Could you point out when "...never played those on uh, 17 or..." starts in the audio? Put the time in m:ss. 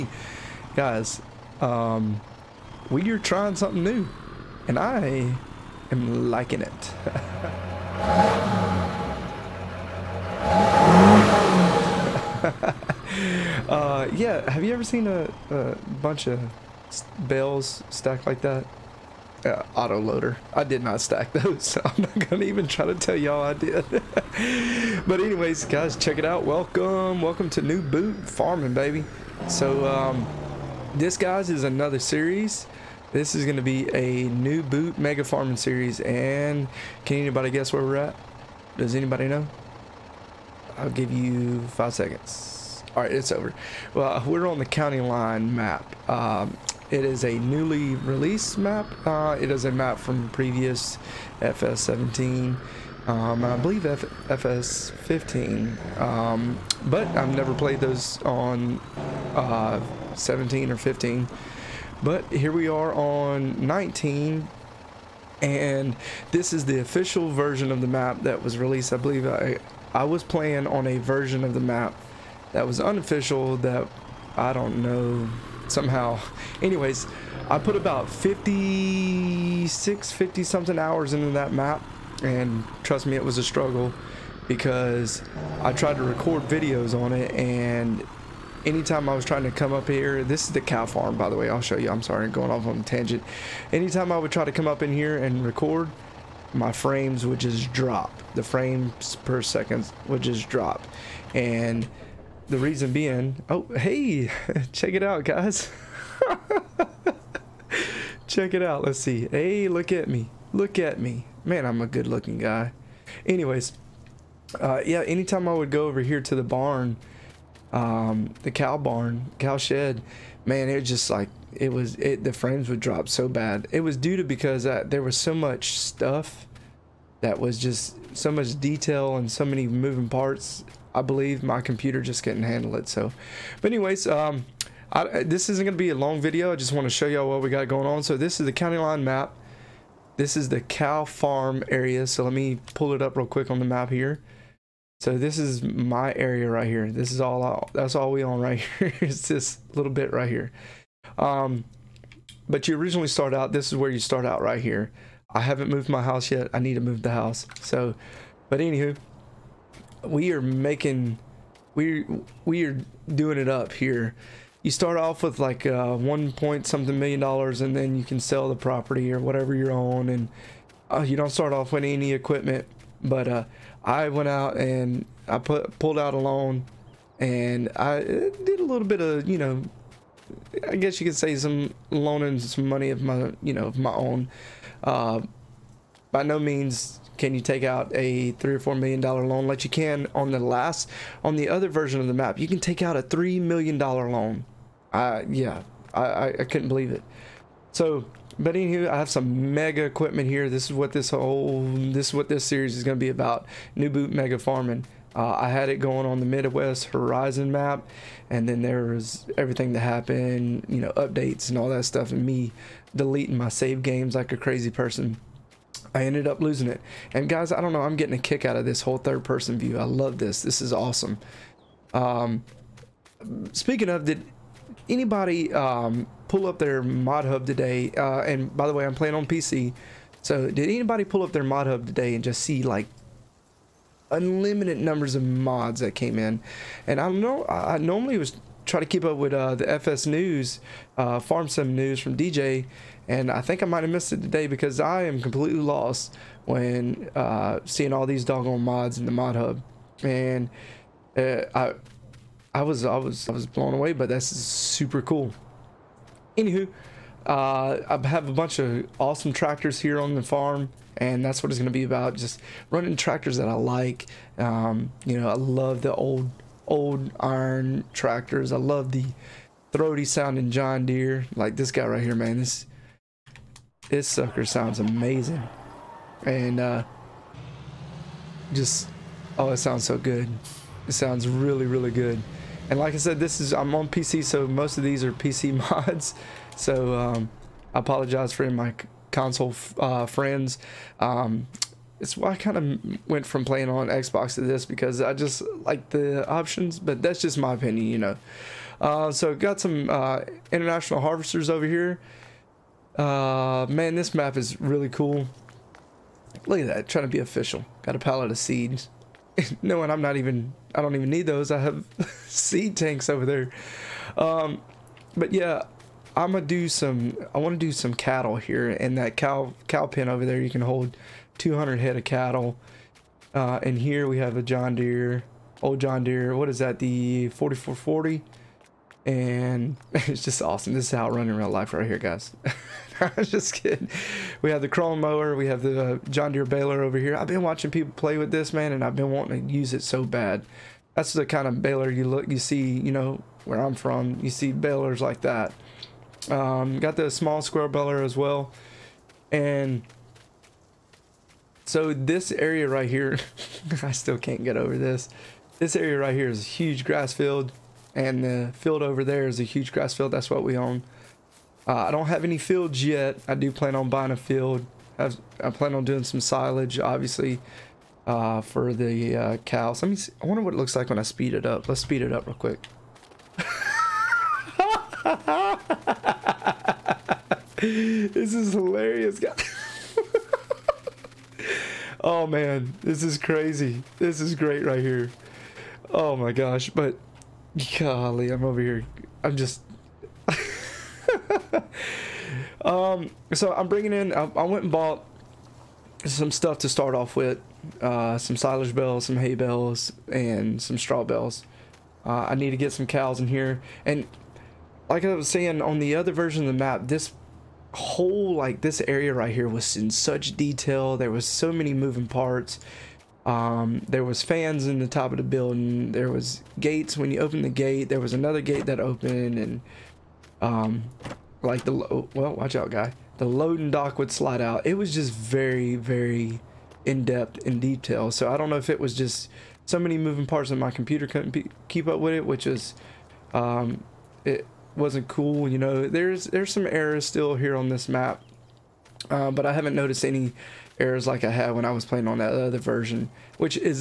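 0:57.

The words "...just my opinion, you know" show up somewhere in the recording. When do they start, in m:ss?
4:57.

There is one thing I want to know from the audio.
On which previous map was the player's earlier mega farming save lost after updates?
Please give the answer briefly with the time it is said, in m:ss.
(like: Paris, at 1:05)
Midwest Horizon, at 3:26.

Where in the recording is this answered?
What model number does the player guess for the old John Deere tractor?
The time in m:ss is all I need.
5:27.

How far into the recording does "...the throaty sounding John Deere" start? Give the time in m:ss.
4:28.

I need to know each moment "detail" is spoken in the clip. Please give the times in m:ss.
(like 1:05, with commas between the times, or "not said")
2:08, 6:50, 7:07.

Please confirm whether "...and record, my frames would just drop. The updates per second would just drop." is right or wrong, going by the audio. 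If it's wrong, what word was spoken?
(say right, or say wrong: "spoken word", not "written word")
wrong: "frames", not "updates".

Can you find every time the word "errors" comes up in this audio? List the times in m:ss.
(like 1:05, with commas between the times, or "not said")
7:16, 7:20.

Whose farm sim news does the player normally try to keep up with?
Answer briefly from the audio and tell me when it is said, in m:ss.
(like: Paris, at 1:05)
DJ, at 4:02.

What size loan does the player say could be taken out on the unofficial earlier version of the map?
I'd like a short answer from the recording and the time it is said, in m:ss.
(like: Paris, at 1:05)
3 million dollars, at 3:13.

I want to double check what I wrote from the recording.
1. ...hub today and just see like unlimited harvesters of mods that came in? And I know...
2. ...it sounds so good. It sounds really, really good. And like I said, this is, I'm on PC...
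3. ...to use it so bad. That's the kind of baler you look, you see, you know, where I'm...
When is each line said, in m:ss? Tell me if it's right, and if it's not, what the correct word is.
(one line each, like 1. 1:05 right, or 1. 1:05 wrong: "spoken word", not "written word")
1. 3:51 wrong: "numbers", not "harvesters"
2. 4:39 right
3. 5:39 right.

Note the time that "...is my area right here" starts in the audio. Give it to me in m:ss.
2:25.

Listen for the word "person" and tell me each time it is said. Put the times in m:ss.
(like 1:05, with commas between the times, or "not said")
3:34, 3:39.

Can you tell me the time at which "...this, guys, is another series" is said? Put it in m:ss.
0:30.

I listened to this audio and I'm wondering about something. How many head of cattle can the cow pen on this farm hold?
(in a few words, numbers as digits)
200.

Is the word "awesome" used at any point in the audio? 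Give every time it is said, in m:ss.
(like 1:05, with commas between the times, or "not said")
3:40, 4:18, 5:30.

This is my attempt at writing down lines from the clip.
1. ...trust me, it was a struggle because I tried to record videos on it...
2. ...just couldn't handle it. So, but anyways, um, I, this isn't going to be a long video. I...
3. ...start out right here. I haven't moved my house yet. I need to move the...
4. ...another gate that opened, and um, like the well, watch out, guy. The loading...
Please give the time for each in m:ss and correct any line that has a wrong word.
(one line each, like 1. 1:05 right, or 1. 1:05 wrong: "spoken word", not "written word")
1. 1:22 right
2. 2:12 right
3. 2:33 right
4. 6:58 right.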